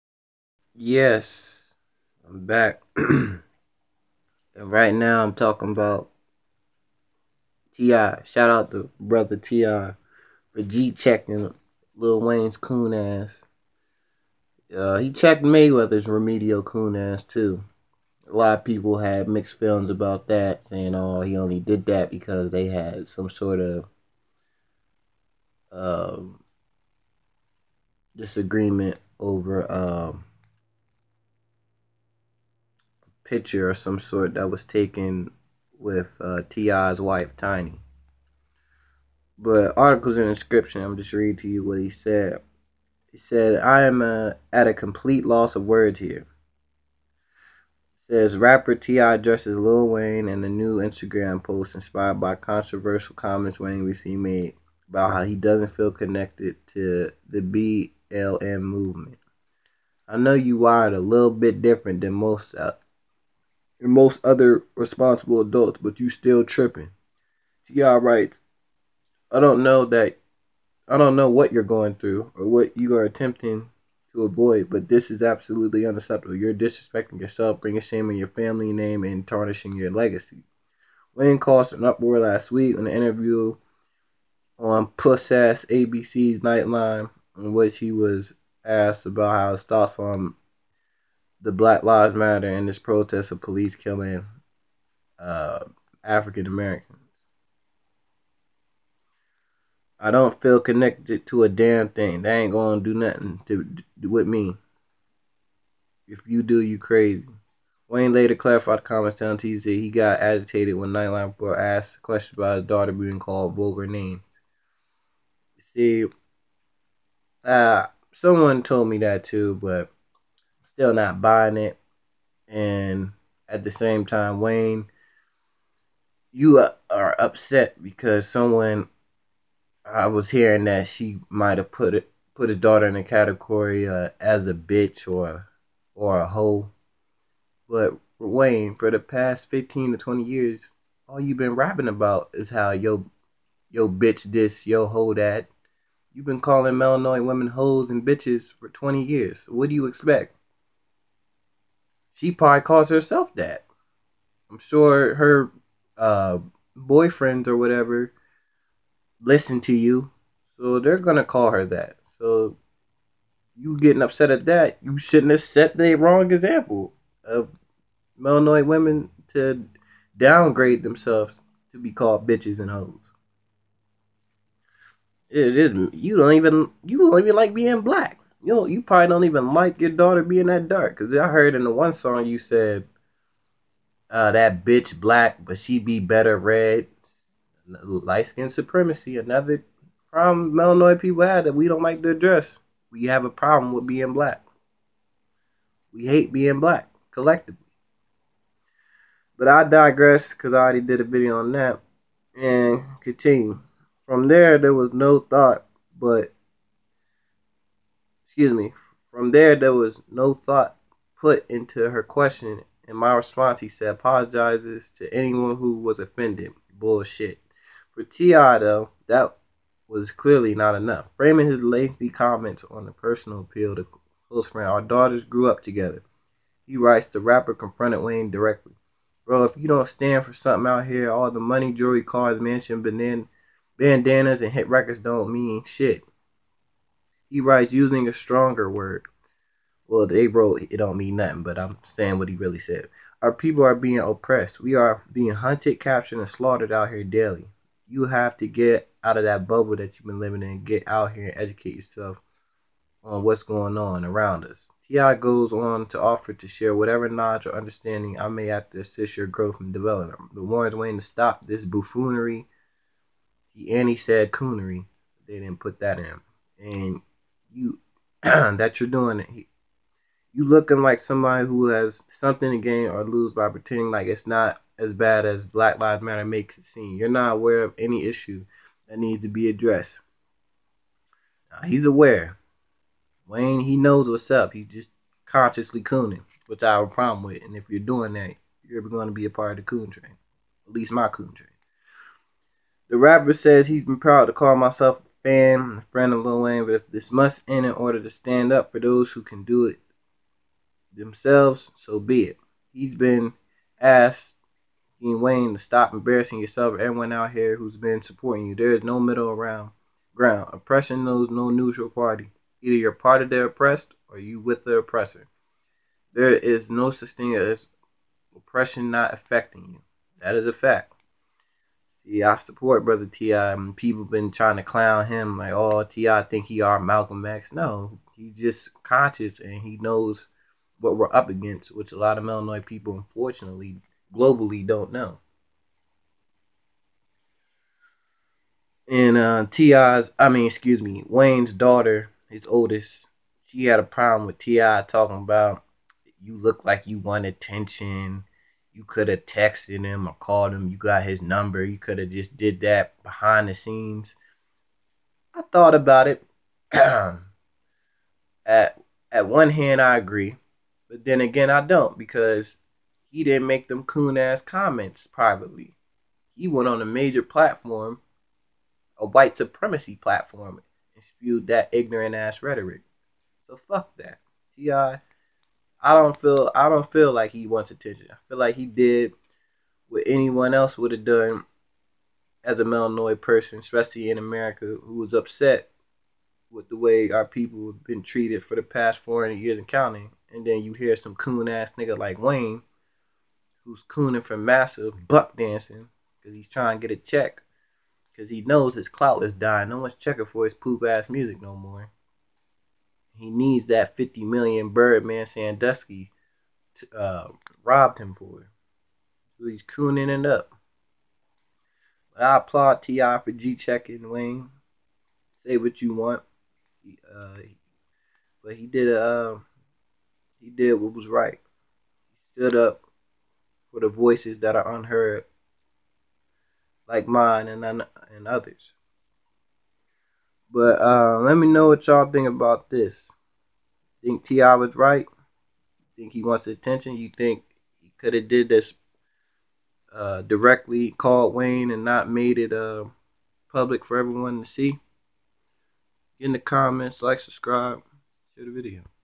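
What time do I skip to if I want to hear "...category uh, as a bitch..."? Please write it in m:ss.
2:13.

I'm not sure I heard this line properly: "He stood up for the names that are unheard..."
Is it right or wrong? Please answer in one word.
wrong.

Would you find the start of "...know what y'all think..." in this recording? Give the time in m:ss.
7:11.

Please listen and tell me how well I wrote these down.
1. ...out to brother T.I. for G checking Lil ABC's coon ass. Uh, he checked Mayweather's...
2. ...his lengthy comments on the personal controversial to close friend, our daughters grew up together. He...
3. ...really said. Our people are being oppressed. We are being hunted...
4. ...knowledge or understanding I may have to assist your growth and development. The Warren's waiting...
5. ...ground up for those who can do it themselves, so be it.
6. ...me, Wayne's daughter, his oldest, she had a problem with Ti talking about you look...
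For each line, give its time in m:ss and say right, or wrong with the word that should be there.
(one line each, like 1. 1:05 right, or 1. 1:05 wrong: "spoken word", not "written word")
1. 0:08 wrong: "Wayne", not "ABC"
2. 3:41 wrong: "appeal", not "controversial"
3. 4:02 right
4. 4:17 right
5. 4:58 wrong: "stand", not "ground"
6. 5:40 right.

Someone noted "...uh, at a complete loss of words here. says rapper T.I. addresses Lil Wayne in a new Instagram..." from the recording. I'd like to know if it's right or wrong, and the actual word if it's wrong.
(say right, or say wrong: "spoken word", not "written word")
right.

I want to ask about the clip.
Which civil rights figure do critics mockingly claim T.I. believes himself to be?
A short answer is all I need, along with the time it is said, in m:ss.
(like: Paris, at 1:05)
Malcolm X, at 5:26.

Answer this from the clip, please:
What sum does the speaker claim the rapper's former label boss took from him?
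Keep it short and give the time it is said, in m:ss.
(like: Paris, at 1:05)
50 million, at 6:43.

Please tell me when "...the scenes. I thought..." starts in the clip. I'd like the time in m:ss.
5:53.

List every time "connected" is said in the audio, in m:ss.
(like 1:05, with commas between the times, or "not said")
0:55, 1:40.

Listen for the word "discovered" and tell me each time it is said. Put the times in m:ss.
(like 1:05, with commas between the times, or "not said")
not said.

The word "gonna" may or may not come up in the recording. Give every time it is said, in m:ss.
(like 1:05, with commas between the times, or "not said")
1:42, 2:40.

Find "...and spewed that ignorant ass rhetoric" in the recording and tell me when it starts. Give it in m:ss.
6:10.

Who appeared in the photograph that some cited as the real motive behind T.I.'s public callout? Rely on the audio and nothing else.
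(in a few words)
Tiny.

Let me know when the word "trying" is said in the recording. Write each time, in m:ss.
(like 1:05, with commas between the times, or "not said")
5:24, 6:36.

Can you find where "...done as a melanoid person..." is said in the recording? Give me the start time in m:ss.
6:21.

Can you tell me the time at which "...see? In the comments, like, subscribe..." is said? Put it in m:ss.
7:24.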